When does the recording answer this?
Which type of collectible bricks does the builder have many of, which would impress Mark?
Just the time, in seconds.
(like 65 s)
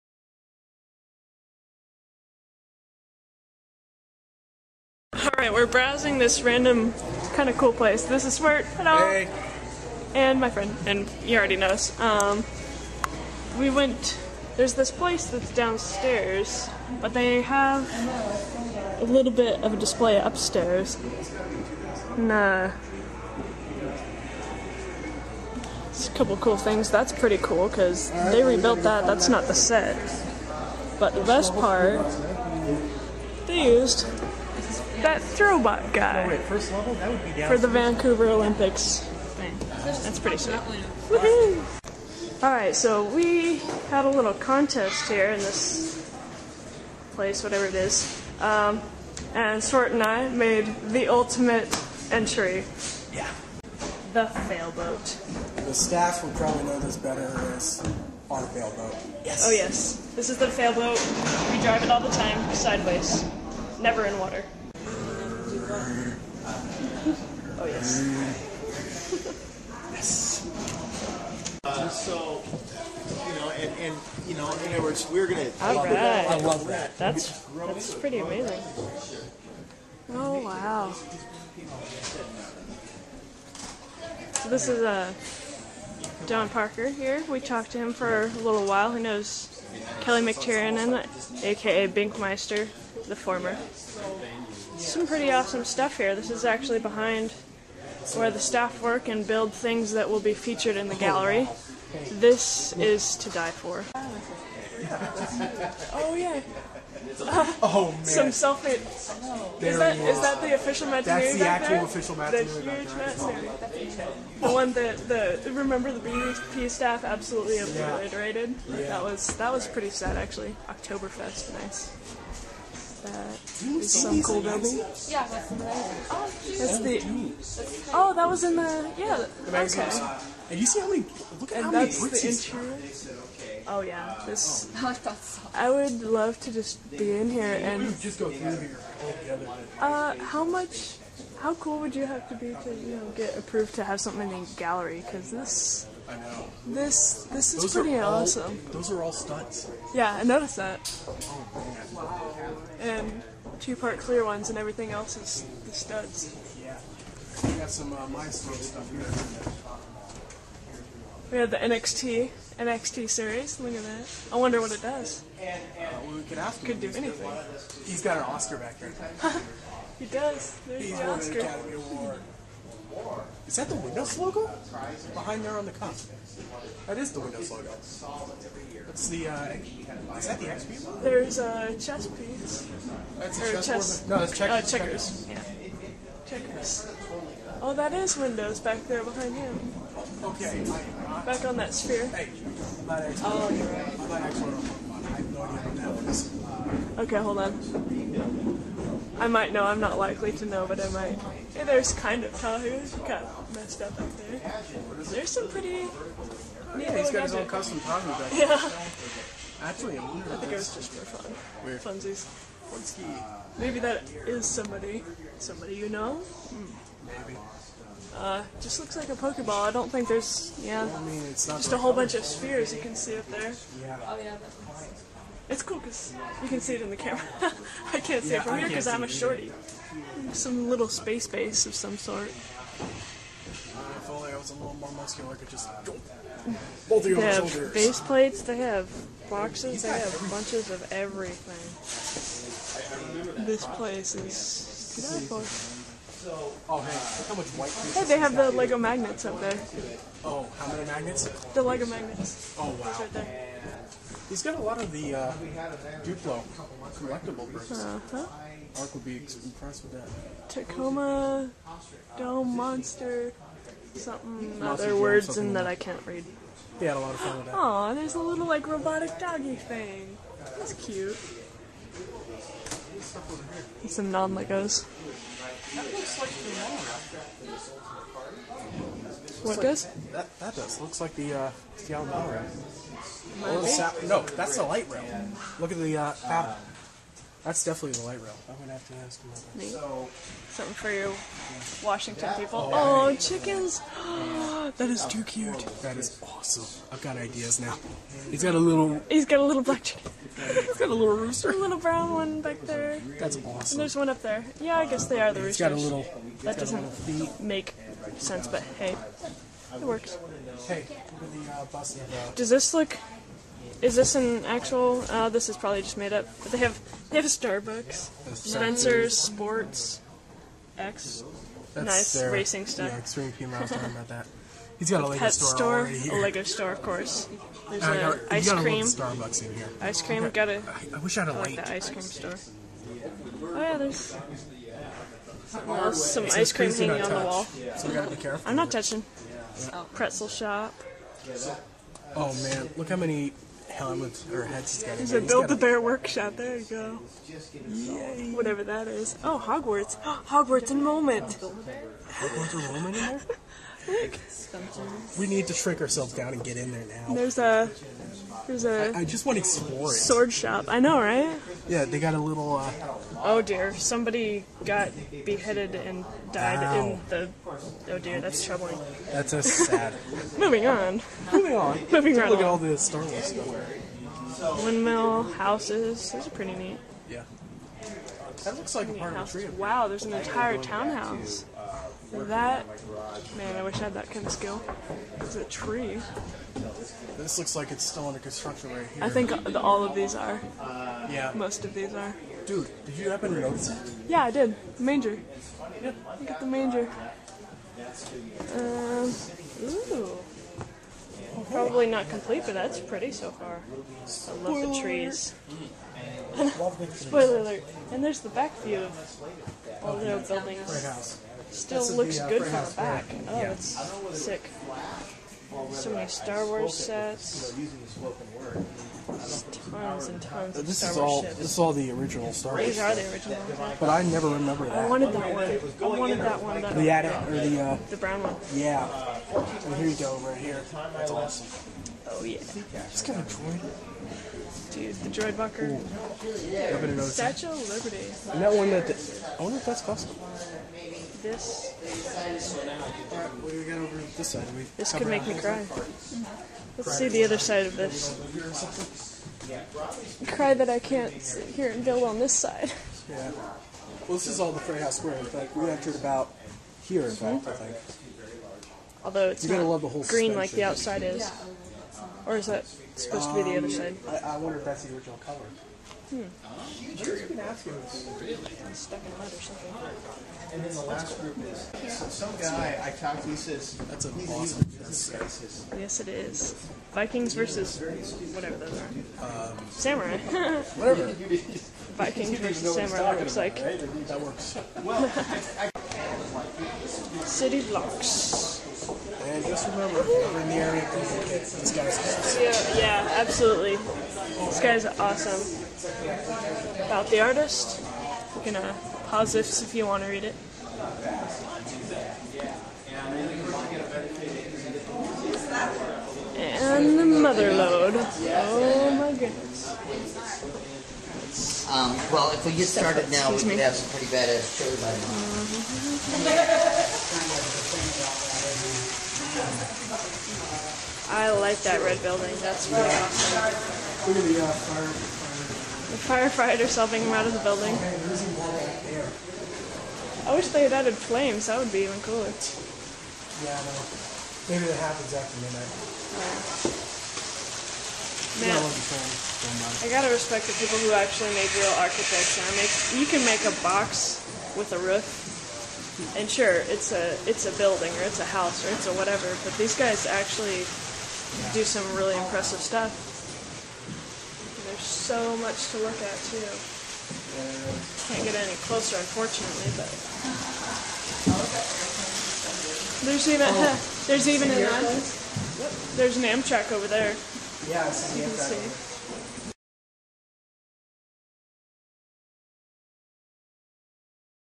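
256 s.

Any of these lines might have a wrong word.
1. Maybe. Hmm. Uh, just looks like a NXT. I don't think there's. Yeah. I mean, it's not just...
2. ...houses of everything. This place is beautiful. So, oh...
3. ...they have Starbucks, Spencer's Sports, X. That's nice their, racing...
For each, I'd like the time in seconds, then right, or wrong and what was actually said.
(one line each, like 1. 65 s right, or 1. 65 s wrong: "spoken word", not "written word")
1. 217 s wrong: "Pokeball", not "NXT"
2. 240 s wrong: "bunches", not "houses"
3. 317 s right.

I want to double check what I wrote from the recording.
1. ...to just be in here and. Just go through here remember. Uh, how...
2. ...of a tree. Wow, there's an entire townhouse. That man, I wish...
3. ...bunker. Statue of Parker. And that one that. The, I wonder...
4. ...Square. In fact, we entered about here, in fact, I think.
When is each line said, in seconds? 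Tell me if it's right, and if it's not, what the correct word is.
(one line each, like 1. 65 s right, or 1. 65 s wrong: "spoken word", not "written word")
1. 136 s wrong: "altogether", not "remember"
2. 379 s right
3. 435 s wrong: "Liberty", not "Parker"
4. 454 s right.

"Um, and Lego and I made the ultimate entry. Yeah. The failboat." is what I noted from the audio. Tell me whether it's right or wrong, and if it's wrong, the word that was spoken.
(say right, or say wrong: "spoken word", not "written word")
wrong: "Swart", not "Lego".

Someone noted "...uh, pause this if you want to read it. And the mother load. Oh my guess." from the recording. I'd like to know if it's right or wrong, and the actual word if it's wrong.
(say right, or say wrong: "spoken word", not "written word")
wrong: "goodness", not "guess".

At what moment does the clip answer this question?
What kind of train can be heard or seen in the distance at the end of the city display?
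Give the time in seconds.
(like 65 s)
566 s.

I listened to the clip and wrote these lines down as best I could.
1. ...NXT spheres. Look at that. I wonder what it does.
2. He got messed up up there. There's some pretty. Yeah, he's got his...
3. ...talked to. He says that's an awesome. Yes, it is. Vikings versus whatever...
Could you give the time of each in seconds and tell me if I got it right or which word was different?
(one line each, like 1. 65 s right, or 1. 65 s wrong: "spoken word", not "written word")
1. 162 s wrong: "series", not "spheres"
2. 202 s right
3. 472 s right.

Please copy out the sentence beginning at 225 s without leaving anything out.
It's cool because you can see it in the camera.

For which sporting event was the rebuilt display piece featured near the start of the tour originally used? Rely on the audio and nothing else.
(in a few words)
Vancouver Olympics.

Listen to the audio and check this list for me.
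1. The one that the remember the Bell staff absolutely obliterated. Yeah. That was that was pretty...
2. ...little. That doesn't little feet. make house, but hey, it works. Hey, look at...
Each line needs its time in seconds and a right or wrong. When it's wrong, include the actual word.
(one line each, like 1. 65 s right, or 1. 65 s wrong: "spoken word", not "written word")
1. 114 s wrong: "BVP", not "Bell"
2. 305 s wrong: "sense", not "house".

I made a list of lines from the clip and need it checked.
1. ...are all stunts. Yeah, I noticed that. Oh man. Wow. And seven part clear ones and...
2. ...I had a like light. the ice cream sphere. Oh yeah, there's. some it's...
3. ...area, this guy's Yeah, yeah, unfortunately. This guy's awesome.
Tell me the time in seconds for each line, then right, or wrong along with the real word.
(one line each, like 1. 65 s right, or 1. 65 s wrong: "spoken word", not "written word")
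1. 148 s wrong: "two", not "seven"
2. 331 s wrong: "store", not "sphere"
3. 490 s wrong: "absolutely", not "unfortunately".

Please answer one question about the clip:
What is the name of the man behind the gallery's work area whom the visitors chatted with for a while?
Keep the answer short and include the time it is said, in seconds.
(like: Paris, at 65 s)
John Parker, at 86 s.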